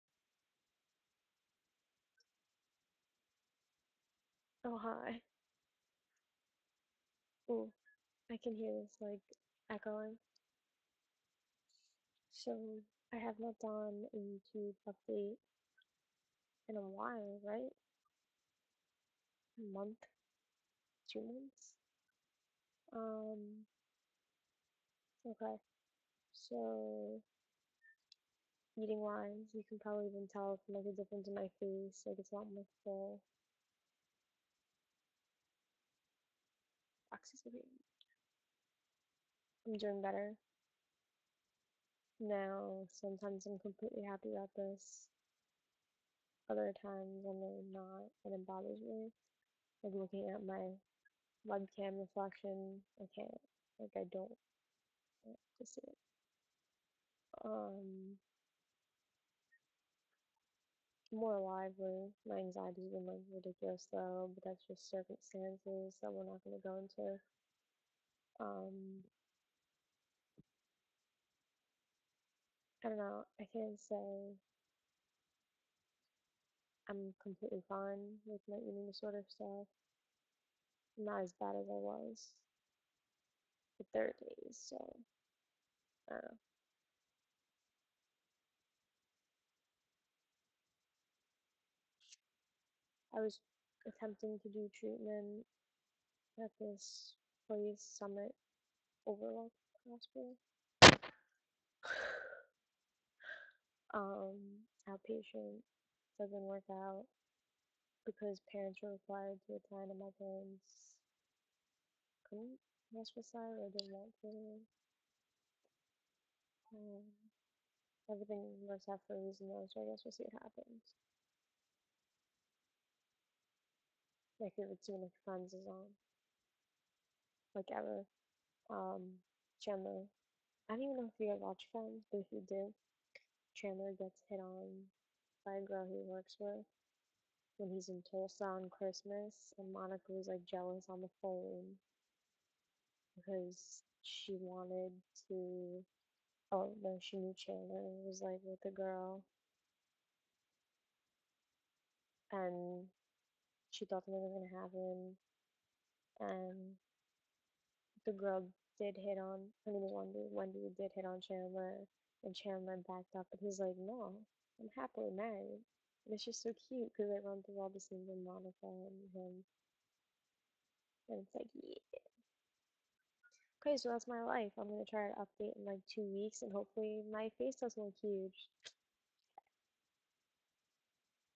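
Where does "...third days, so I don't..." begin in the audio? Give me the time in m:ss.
1:23.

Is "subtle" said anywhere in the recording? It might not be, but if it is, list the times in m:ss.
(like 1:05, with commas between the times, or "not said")
not said.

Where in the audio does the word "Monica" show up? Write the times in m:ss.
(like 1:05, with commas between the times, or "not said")
2:19, 2:48.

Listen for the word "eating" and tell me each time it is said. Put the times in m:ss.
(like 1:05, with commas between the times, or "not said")
0:28, 1:18.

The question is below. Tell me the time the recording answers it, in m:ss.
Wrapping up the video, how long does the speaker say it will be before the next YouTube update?
2:55.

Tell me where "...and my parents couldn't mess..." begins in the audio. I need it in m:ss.
1:49.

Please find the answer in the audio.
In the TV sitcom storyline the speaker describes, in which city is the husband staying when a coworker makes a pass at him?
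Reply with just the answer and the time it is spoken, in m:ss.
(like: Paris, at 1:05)
Tulsa, at 2:18.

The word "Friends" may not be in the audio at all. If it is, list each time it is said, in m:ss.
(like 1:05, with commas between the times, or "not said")
2:05, 2:11.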